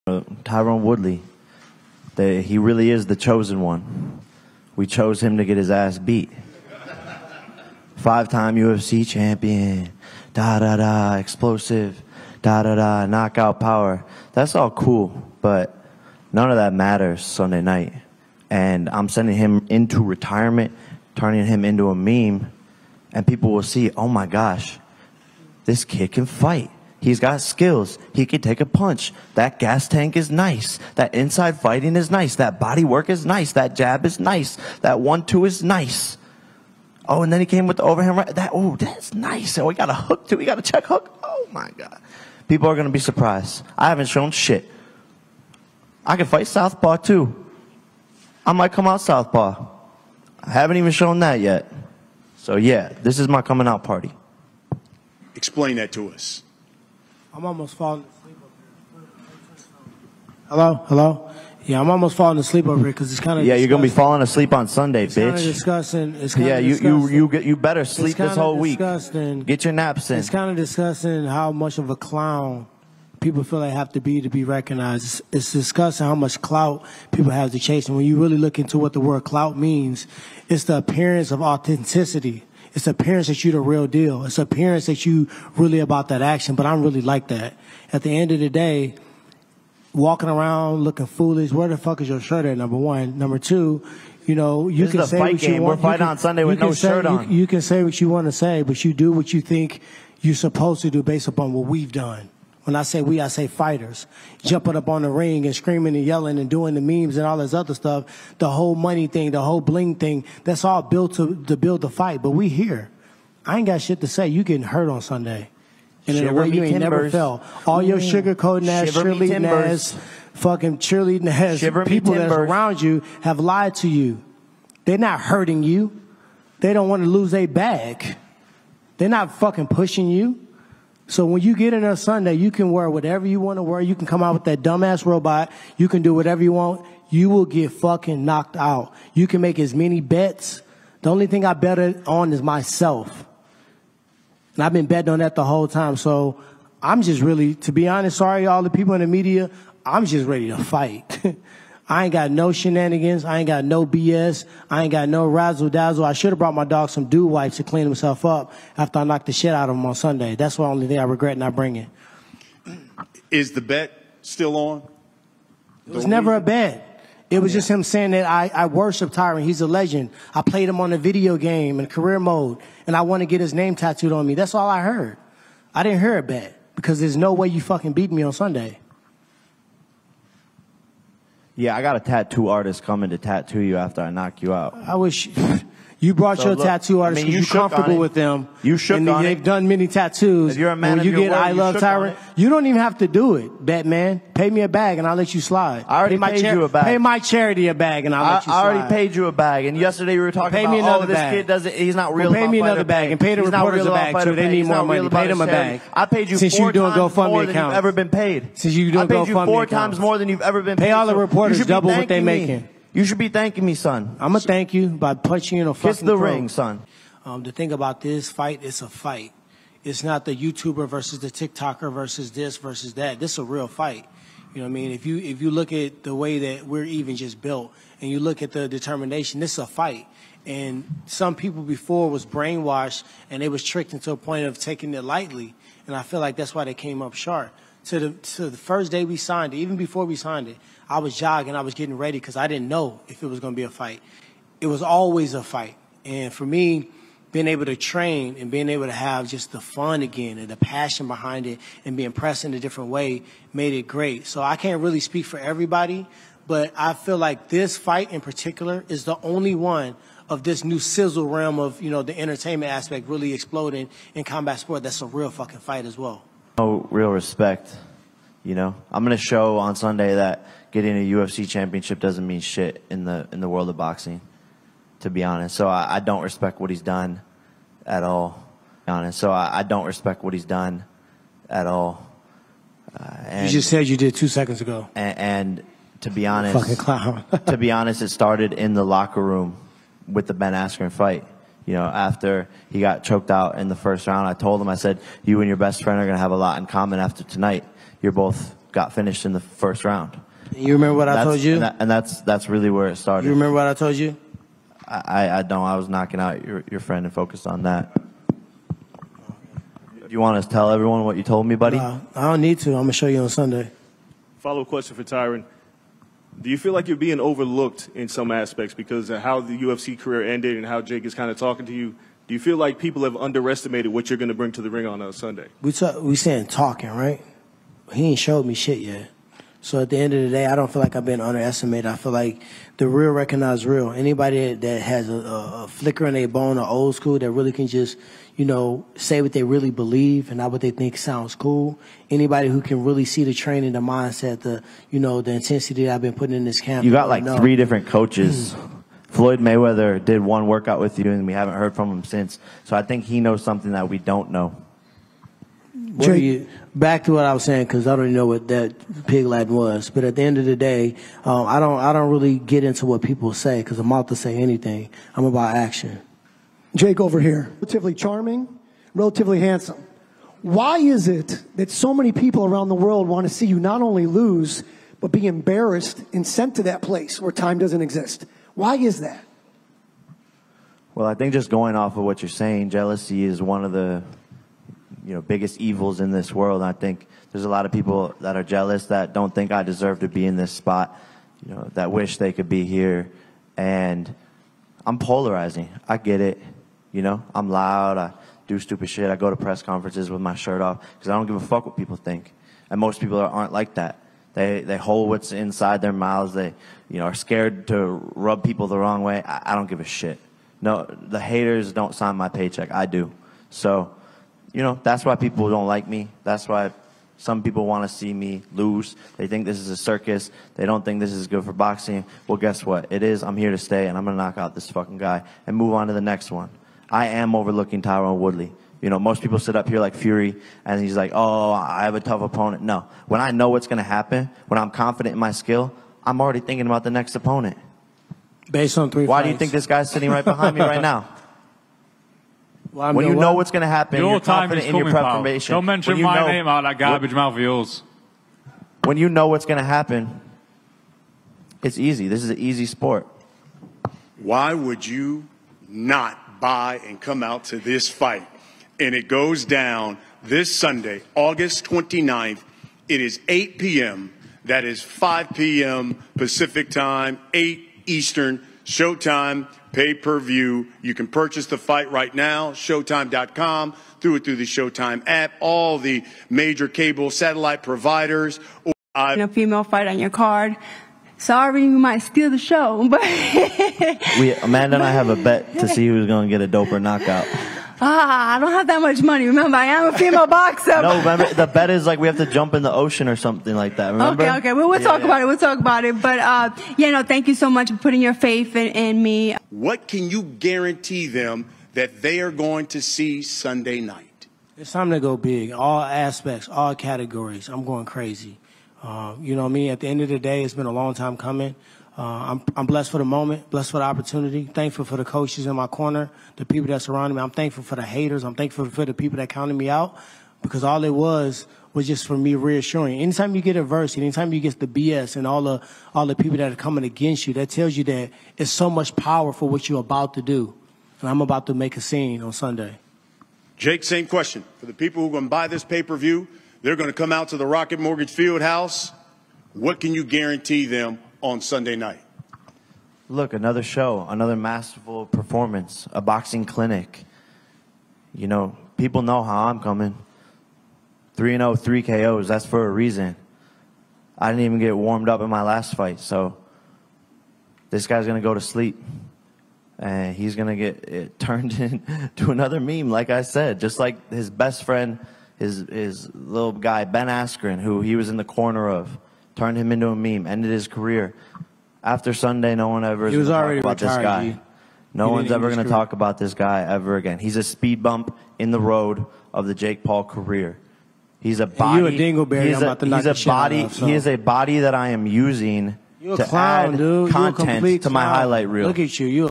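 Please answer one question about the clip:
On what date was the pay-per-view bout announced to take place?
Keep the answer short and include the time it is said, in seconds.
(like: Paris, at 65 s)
August 29th, at 461 s.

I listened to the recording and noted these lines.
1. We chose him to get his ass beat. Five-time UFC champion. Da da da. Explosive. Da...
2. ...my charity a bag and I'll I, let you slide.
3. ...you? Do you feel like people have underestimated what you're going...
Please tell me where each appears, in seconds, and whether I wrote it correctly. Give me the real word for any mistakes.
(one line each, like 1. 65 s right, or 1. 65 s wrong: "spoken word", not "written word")
1. 4 s right
2. 196 s right
3. 321 s right.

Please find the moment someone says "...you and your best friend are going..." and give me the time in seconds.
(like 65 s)
295 s.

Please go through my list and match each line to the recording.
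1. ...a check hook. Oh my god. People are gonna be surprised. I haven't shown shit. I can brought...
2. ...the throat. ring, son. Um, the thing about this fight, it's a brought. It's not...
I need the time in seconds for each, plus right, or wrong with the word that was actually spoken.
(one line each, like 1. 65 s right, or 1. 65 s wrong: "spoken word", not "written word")
1. 40 s wrong: "fight", not "brought"
2. 216 s wrong: "fight", not "brought".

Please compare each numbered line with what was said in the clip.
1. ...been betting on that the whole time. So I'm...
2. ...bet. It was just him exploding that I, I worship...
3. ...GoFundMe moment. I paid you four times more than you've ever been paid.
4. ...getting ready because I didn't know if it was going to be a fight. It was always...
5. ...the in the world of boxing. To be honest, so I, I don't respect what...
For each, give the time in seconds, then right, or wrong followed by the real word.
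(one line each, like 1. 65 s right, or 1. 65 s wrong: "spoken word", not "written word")
1. 144 s right
2. 166 s wrong: "saying", not "exploding"
3. 209 s wrong: "account", not "moment"
4. 241 s right
5. 273 s right.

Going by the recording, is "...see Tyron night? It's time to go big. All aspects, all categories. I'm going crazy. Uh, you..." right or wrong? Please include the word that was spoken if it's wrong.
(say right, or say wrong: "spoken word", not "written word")
wrong: "Sunday", not "Tyron".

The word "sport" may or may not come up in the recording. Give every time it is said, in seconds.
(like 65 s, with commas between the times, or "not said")
264 s, 452 s.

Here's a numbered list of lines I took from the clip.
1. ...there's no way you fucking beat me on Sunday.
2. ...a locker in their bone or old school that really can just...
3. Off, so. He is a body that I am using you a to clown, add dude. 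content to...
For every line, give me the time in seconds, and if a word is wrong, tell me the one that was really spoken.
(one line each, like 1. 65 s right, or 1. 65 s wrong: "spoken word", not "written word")
1. 177 s right
2. 335 s wrong: "flicker", not "locker"
3. 583 s right.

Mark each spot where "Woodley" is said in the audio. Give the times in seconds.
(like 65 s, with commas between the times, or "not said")
0 s, 428 s.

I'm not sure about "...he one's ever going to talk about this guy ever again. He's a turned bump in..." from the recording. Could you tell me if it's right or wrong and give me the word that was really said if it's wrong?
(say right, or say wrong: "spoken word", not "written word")
wrong: "speed", not "turned".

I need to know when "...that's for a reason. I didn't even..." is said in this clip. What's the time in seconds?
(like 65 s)
552 s.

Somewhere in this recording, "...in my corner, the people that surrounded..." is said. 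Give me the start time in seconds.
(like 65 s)
515 s.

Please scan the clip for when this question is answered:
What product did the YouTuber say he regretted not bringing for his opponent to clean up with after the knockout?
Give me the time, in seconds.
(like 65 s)
157 s.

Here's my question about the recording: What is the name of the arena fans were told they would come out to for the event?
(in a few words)
Rocket Mortgage Field House.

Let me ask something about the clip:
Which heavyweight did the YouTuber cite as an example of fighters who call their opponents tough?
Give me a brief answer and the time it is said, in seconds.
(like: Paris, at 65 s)
Fury, at 429 s.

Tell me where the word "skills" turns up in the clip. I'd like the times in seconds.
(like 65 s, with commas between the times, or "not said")
27 s, 435 s.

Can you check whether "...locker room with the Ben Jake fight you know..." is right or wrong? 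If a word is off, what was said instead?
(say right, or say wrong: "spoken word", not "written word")
wrong: "Askren", not "Jake".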